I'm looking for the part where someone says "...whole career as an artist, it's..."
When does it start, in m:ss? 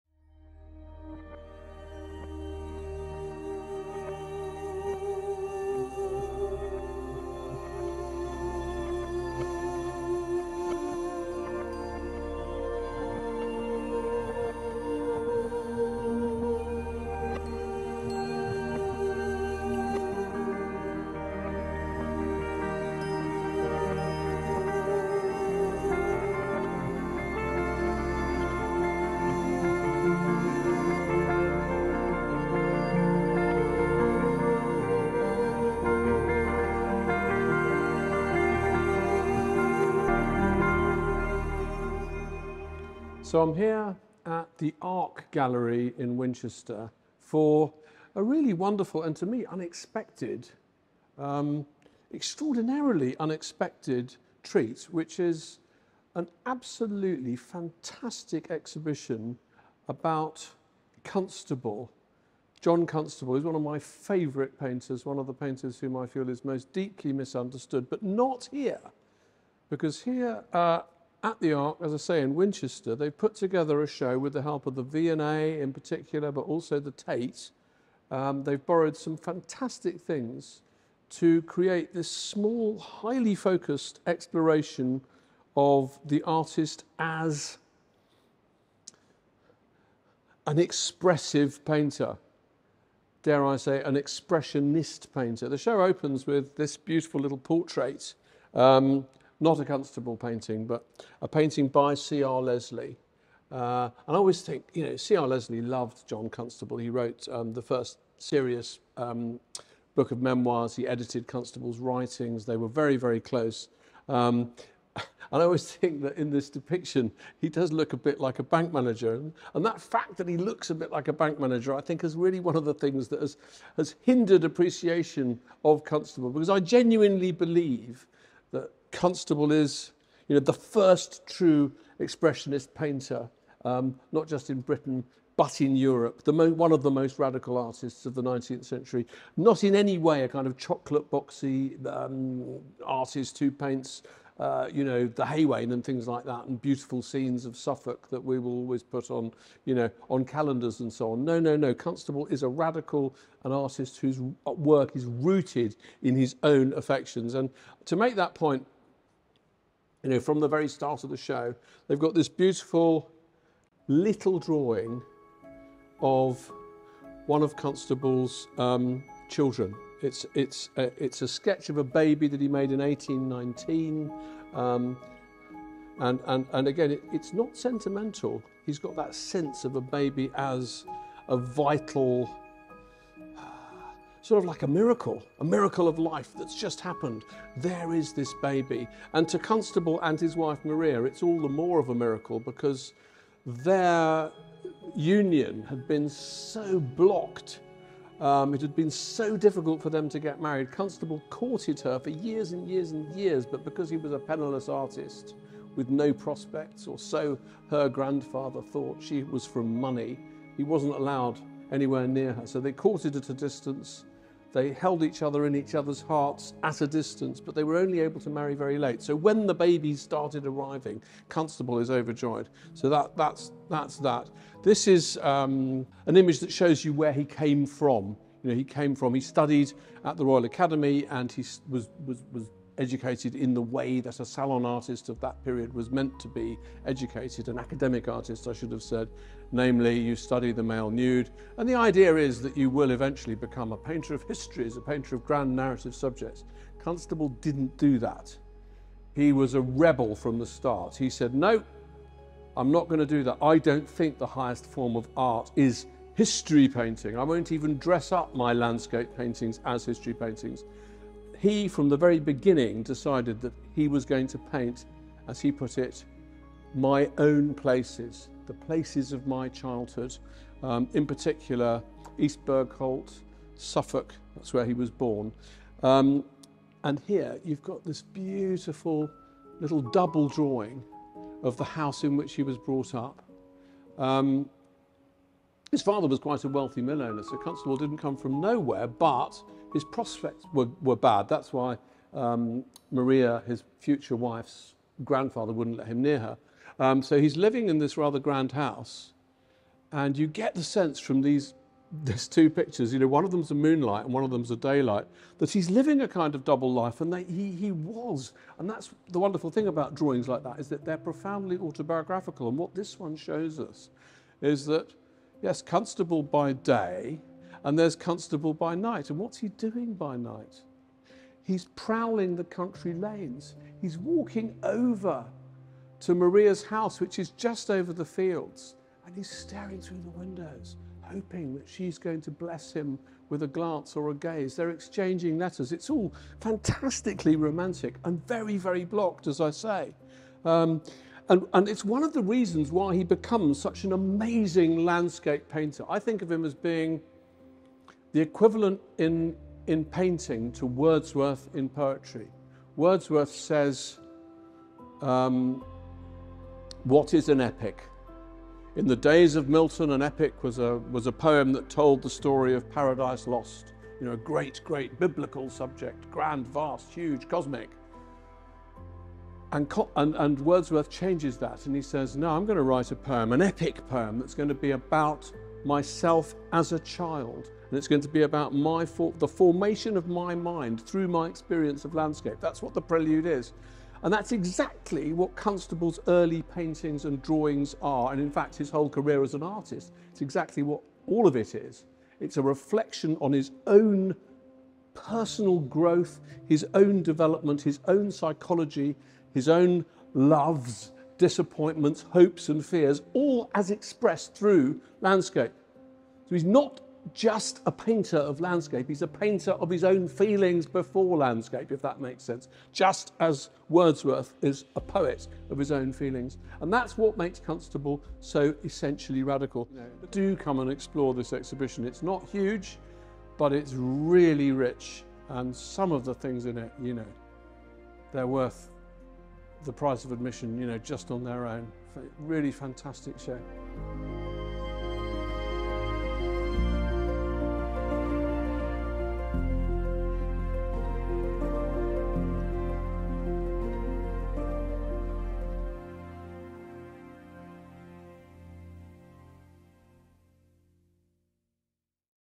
6:28.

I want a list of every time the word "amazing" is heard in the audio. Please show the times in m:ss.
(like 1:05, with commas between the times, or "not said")
5:43.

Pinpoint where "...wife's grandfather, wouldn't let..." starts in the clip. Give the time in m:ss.
4:54.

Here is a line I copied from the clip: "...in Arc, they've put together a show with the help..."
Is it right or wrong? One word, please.
wrong.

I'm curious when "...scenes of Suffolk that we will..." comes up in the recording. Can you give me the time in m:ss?
2:27.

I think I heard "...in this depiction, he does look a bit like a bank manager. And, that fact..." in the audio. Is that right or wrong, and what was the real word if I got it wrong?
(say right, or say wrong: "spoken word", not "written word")
right.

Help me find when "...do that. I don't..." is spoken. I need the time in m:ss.
4:13.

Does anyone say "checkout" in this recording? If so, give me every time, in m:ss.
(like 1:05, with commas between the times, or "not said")
not said.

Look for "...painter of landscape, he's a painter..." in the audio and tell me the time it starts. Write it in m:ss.
6:47.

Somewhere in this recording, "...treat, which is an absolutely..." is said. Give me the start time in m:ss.
0:54.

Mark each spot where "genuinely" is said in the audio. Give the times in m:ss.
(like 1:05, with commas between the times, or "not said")
2:06.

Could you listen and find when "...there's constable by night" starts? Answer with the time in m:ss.
5:17.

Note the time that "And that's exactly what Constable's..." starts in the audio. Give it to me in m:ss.
6:24.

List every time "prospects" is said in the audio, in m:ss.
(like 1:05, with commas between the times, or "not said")
3:26, 4:49.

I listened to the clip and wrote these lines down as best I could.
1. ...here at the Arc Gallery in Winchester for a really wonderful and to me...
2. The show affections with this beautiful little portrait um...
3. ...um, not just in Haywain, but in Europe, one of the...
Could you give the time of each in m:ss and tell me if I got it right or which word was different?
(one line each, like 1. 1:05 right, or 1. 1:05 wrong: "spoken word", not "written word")
1. 0:43 right
2. 1:35 wrong: "opens", not "affections"
3. 2:13 wrong: "Britain", not "Haywain".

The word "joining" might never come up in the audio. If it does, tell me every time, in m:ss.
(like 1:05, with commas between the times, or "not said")
not said.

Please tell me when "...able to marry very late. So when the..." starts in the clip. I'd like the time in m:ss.
3:38.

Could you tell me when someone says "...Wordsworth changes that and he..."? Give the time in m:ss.
6:10.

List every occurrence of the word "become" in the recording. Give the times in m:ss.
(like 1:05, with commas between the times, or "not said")
4:03, 5:43.